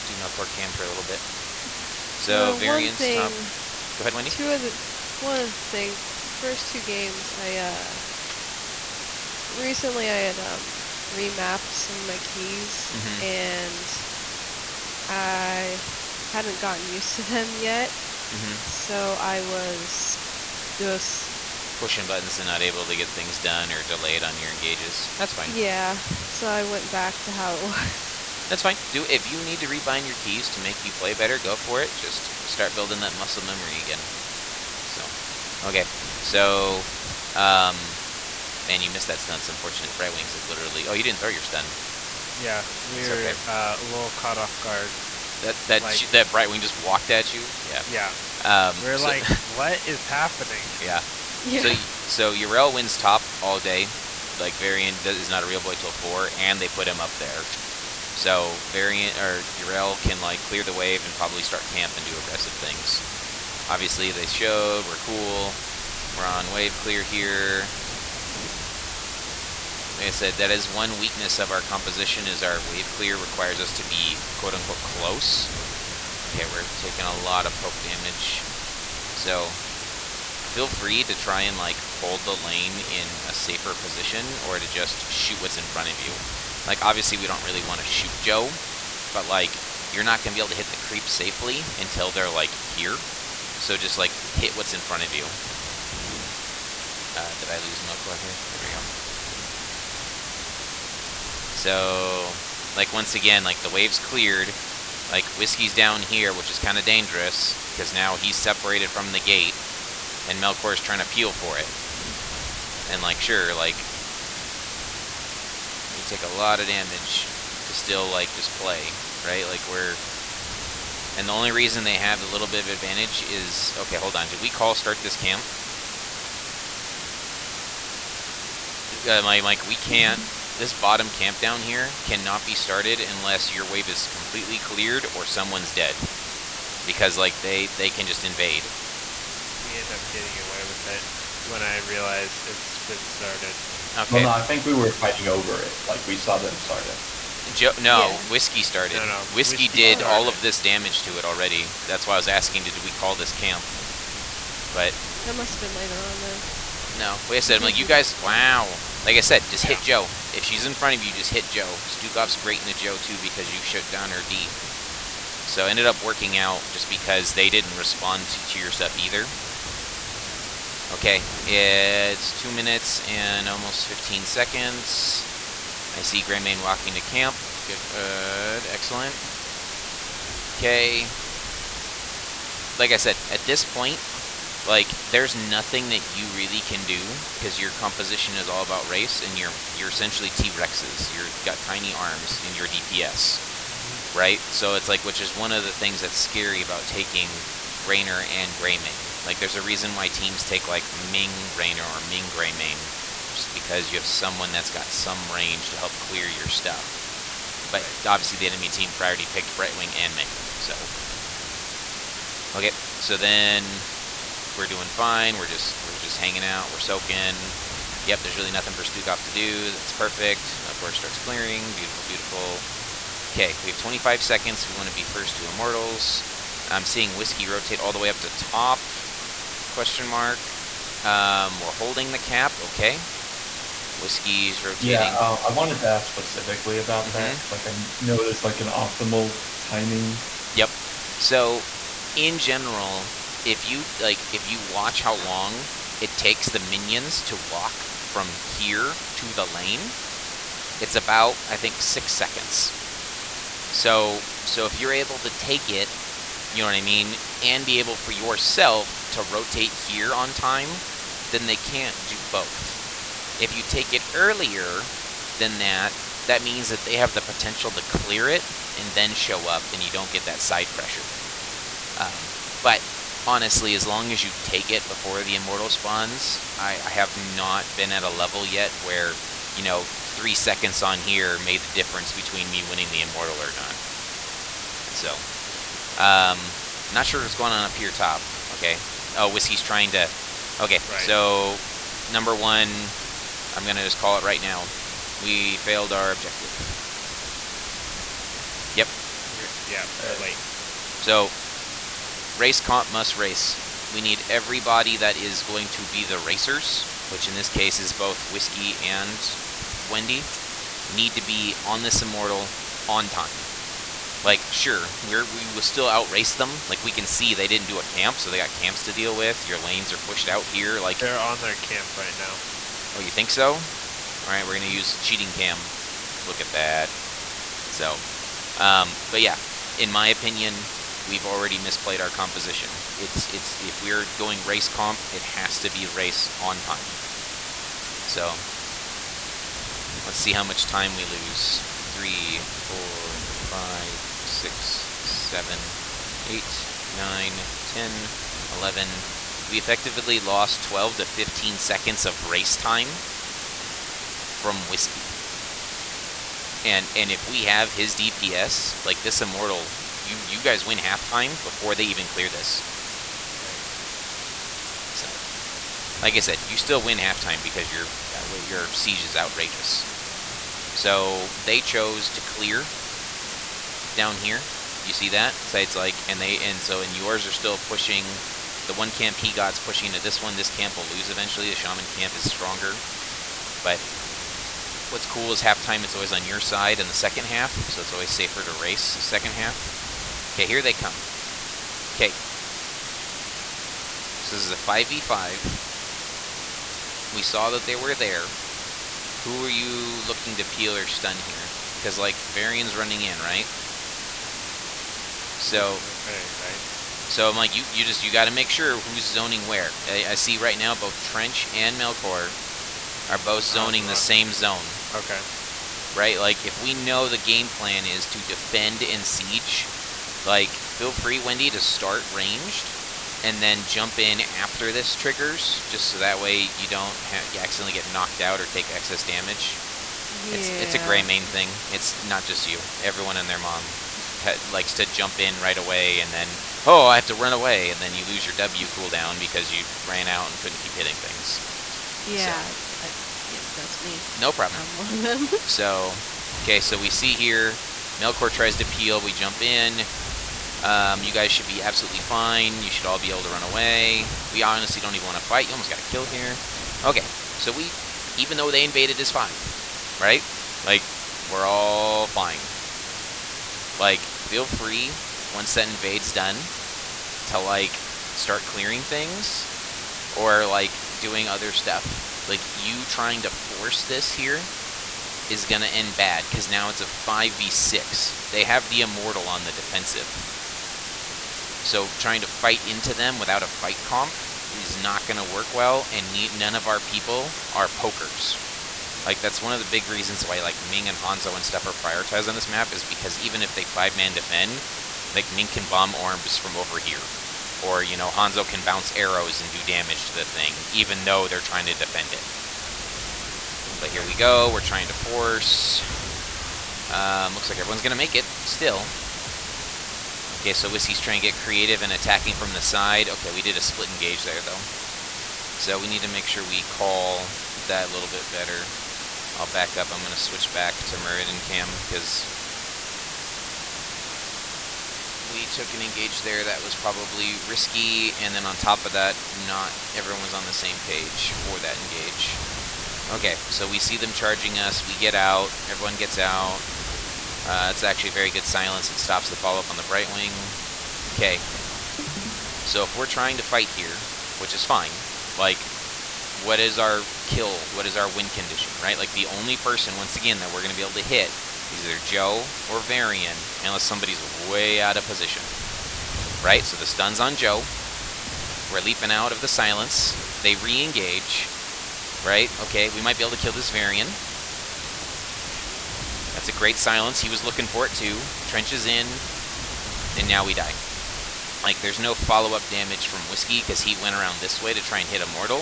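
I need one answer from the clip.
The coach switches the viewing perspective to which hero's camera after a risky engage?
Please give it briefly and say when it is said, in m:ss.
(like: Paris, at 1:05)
Muradin, at 8:40.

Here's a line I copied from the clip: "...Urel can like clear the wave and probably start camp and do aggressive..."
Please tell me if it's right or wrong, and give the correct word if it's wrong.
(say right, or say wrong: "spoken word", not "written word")
right.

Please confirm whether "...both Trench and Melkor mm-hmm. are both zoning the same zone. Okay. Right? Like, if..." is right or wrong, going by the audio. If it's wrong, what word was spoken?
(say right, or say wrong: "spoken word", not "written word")
right.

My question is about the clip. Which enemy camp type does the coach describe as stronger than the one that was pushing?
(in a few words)
shaman camp.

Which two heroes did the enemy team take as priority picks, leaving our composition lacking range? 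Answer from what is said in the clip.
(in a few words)
Brightwing and Ming.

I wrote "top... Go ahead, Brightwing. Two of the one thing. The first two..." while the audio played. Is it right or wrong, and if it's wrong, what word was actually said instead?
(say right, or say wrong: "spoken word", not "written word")
wrong: "Wendy", not "Brightwing".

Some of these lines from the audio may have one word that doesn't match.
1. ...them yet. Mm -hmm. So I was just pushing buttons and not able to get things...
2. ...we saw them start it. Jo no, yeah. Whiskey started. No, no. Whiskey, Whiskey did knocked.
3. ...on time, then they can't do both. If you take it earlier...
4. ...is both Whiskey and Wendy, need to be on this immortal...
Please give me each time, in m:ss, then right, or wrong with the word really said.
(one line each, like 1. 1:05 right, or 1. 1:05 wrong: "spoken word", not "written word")
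1. 0:17 right
2. 2:26 wrong: "started", not "knocked"
3. 4:20 right
4. 5:07 right.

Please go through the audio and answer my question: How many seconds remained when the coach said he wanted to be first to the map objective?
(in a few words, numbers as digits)
25.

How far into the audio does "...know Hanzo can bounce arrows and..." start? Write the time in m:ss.
8:17.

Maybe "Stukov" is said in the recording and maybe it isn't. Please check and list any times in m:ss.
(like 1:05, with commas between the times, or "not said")
2:41, 3:38.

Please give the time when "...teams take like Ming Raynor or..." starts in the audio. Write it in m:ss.
3:20.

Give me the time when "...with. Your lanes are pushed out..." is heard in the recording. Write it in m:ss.
5:19.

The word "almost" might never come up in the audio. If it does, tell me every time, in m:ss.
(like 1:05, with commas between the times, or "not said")
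2:53, 7:35.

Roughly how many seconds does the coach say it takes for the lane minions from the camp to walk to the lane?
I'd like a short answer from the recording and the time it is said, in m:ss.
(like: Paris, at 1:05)
6, at 4:11.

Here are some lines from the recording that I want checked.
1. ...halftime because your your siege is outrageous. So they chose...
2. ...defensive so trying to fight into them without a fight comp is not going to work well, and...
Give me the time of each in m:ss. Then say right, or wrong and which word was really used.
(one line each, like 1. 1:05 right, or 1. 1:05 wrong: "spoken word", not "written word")
1. 6:06 right
2. 7:59 right.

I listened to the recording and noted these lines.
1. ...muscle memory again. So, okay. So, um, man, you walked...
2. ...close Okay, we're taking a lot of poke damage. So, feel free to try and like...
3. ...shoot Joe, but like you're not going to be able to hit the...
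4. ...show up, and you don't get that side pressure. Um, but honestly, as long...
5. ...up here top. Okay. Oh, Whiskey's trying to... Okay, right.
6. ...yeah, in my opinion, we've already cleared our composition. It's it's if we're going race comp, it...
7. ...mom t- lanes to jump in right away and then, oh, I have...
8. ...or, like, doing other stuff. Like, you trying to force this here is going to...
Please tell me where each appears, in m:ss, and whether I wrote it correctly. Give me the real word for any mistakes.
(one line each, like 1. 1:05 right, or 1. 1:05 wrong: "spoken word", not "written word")
1. 0:33 wrong: "missed", not "walked"
2. 1:14 right
3. 1:27 right
4. 4:29 right
5. 4:47 right
6. 5:29 wrong: "misplayed", not "cleared"
7. 7:13 wrong: "likes", not "lanes"
8. 7:50 right.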